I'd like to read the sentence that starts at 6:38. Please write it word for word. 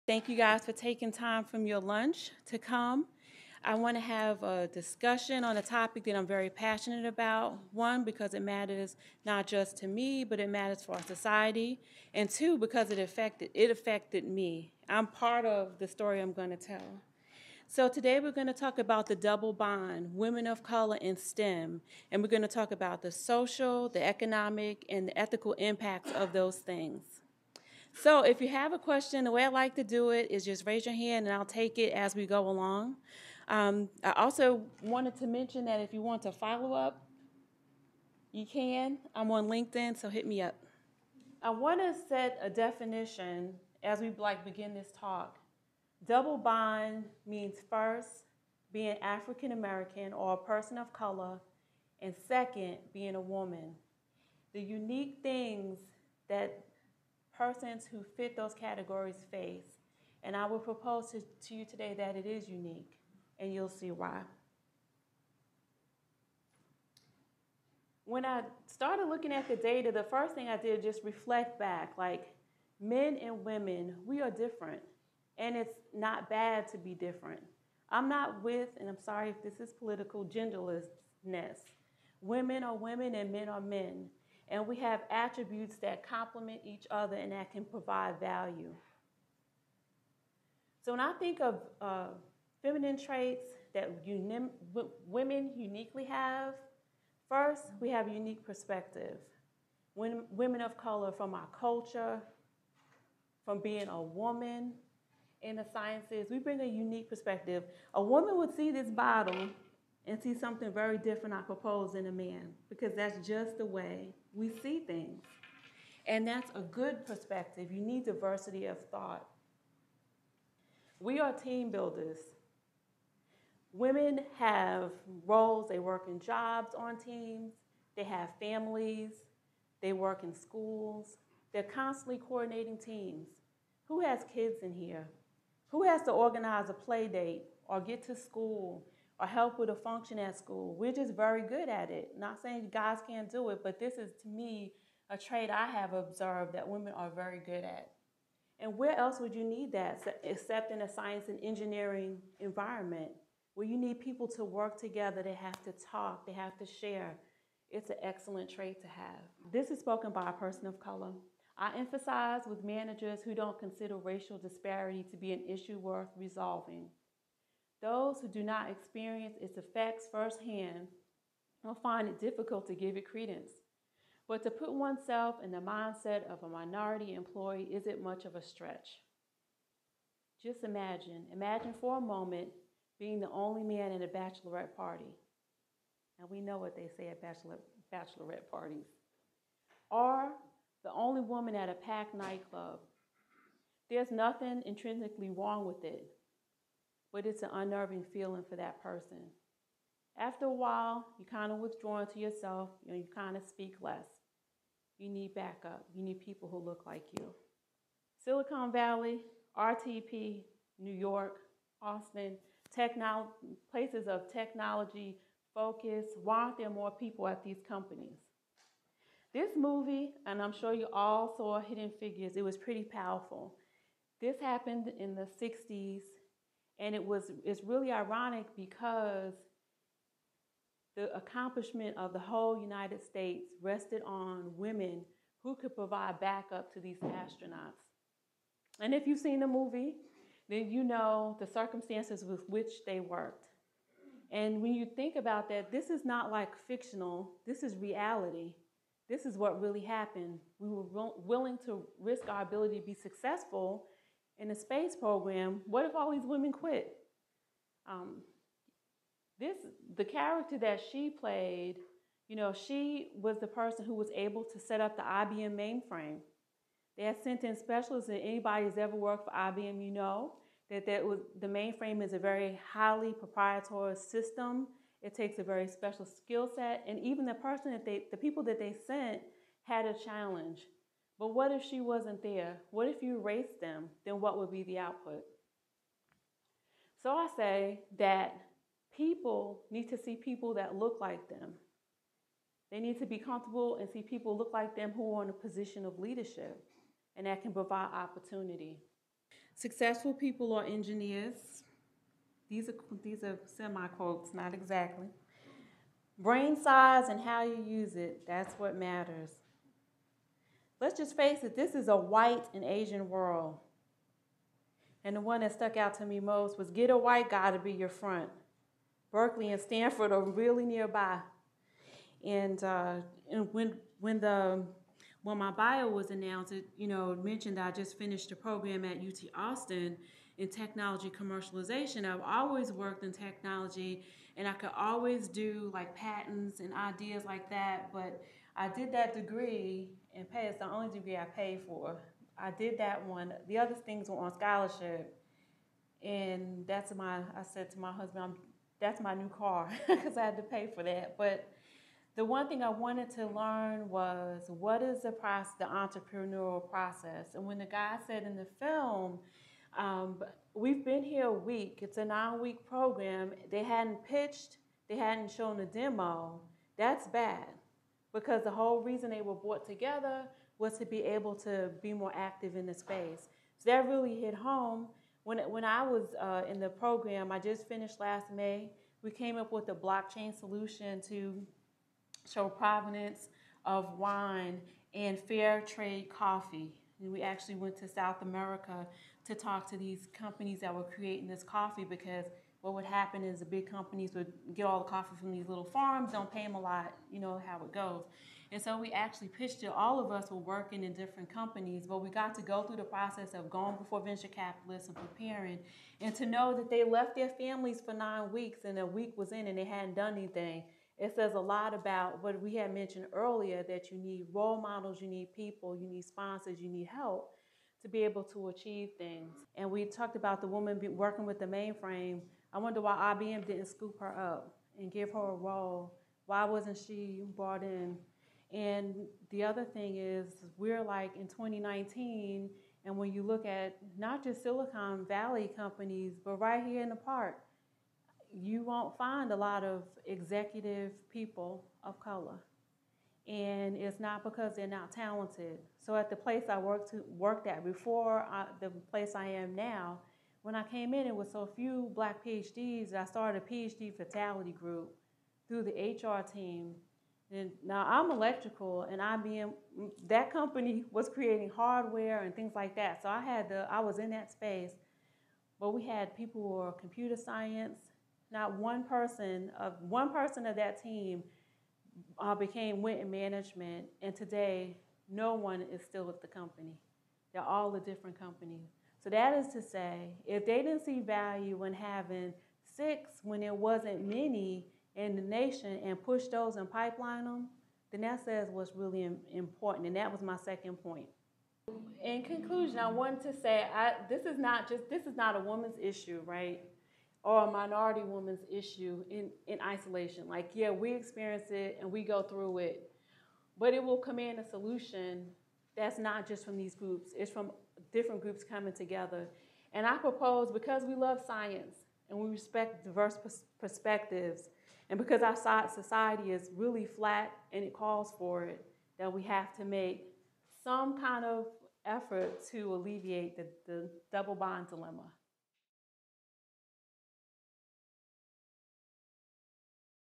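And so we actually pitched it.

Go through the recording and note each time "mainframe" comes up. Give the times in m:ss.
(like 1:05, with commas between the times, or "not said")
4:25, 4:31, 7:01.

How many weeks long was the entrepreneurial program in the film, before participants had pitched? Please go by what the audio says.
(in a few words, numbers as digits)
9.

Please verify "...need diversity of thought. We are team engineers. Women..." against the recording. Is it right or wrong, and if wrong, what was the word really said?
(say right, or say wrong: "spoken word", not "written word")
wrong: "builders", not "engineers".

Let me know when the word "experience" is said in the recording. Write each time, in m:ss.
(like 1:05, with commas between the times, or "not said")
2:48, 8:20.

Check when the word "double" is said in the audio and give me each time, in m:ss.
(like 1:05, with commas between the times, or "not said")
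0:19, 0:46, 8:44.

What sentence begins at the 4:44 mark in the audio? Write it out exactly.
Then what would be the output?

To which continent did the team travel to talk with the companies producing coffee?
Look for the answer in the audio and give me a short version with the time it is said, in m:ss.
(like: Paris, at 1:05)
South America, at 6:27.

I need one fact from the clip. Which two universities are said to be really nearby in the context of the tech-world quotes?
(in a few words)
Berkeley and Stanford.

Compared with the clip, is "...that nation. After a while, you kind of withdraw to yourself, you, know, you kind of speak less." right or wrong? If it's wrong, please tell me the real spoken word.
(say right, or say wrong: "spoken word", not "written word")
wrong: "person", not "nation".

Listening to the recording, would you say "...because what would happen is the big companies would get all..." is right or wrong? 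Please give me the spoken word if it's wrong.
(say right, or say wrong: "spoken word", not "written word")
right.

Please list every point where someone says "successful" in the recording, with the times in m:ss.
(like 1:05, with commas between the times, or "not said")
4:12, 4:59.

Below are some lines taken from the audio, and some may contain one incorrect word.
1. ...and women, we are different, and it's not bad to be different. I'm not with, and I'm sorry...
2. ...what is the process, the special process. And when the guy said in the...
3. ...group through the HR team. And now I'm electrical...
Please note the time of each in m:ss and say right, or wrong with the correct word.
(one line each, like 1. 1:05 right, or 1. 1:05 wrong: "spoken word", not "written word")
1. 1:13 right
2. 5:54 wrong: "entrepreneurial", not "special"
3. 7:34 right.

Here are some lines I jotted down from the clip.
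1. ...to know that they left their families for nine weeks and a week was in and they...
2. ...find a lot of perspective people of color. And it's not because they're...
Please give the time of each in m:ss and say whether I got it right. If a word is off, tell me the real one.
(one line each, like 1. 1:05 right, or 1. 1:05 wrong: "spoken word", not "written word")
1. 6:46 right
2. 7:18 wrong: "executive", not "perspective".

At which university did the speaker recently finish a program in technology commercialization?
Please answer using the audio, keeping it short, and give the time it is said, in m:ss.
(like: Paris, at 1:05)
UT Austin, at 5:28.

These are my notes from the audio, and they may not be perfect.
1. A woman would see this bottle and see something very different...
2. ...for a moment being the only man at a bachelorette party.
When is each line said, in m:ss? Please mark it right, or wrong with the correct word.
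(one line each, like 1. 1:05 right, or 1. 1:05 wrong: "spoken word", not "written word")
1. 1:47 right
2. 3:01 right.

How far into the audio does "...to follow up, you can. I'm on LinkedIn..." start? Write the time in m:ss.
0:36.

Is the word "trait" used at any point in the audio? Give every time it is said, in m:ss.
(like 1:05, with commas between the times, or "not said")
1:33, 2:25, 2:38.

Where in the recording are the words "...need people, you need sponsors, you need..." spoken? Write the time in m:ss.
6:55.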